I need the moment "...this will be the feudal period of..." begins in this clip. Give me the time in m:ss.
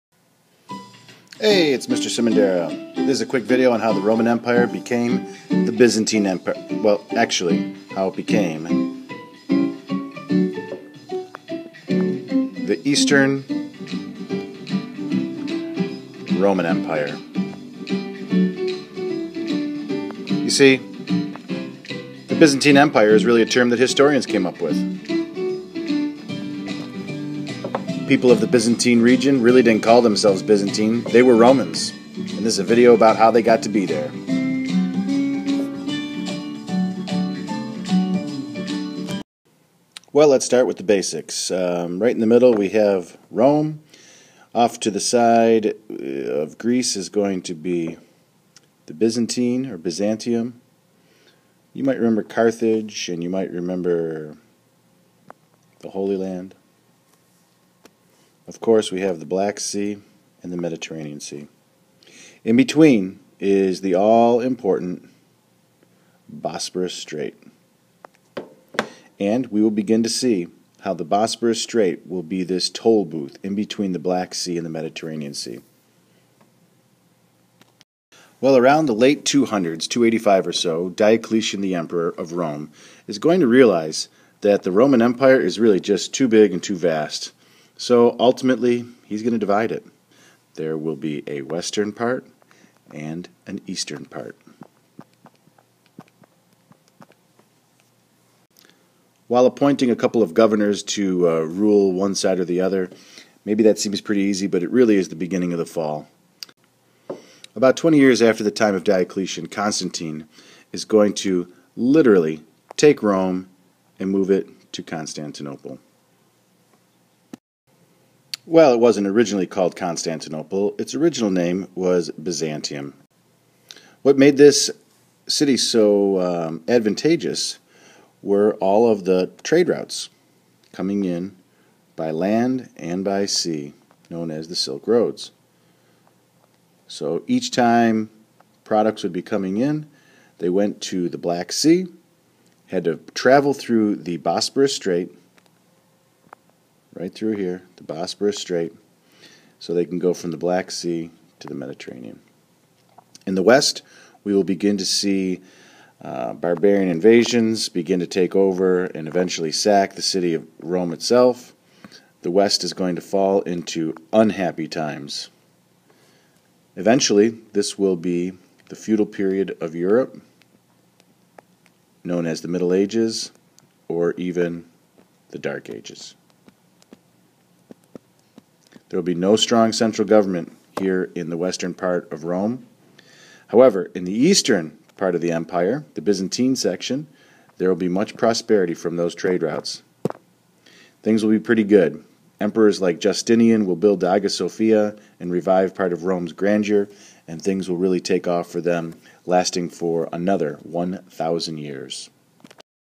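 2:47.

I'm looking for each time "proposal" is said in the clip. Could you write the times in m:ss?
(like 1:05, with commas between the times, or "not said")
not said.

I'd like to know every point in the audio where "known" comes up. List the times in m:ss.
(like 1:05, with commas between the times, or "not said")
2:14, 2:52.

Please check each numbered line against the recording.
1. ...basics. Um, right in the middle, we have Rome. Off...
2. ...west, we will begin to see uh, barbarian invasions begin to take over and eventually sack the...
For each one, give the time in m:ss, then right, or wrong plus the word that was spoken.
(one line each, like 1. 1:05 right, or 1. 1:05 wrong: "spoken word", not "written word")
1. 0:40 right
2. 2:33 right.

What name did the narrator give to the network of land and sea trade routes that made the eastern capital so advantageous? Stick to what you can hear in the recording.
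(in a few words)
Silk Roads.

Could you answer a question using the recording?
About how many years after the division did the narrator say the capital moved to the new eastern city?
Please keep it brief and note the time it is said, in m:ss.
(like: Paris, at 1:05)
20, at 1:47.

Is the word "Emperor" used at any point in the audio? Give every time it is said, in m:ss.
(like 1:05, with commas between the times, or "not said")
1:21, 3:12.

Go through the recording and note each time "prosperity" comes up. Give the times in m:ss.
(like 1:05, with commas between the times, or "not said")
3:08.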